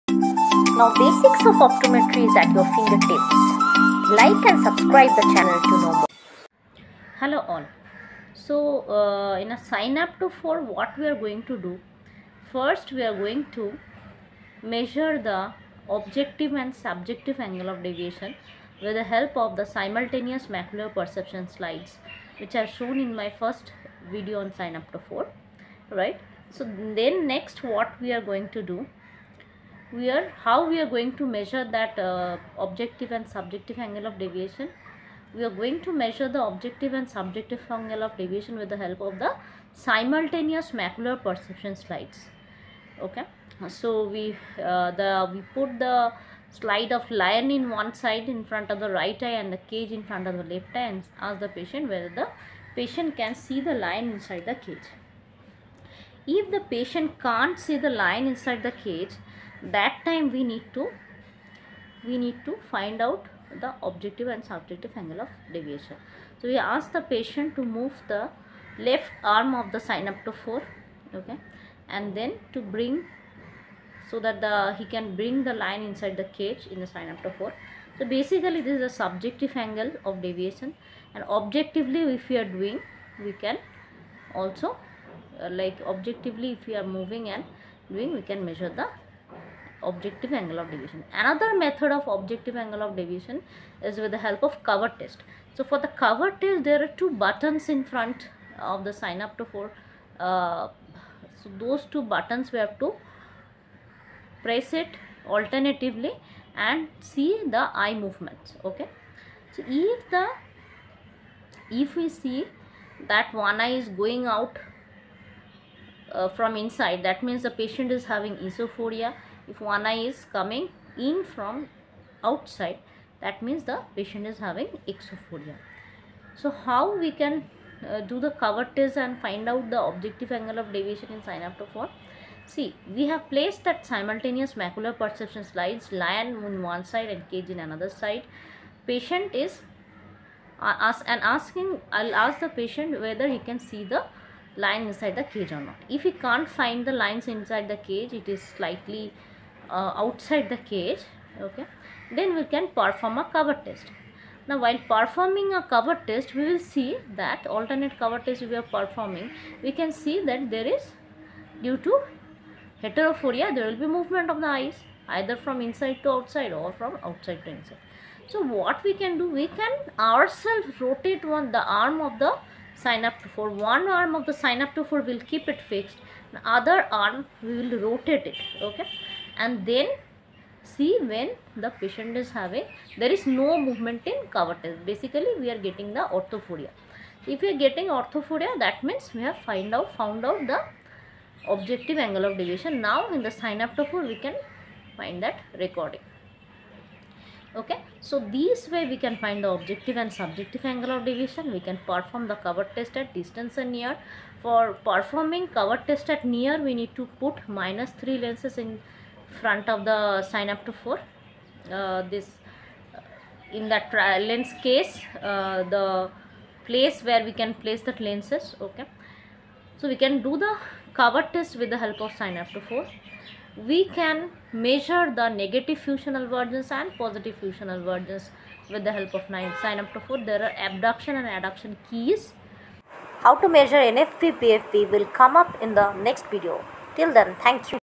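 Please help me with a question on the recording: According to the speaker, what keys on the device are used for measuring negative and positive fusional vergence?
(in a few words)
Abduction and adduction keys.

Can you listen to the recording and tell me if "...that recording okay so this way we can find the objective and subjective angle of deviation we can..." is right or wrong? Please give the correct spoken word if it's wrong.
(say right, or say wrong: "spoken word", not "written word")
right.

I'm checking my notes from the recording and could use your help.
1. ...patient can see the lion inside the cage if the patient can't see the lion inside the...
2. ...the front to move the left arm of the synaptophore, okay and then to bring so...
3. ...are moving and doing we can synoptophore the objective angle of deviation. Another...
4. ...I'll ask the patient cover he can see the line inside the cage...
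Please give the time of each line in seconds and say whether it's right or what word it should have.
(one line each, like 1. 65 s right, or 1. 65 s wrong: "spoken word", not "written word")
1. 52 s right
2. 66 s wrong: "patient", not "front"
3. 86 s wrong: "measure", not "synoptophore"
4. 141 s wrong: "whether", not "cover".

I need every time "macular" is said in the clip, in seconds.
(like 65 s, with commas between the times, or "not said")
20 s, 40 s, 134 s.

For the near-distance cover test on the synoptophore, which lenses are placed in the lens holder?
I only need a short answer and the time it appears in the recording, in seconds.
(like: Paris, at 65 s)
Minus 3 lenses, at 207 s.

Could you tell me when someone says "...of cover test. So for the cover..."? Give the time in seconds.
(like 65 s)
94 s.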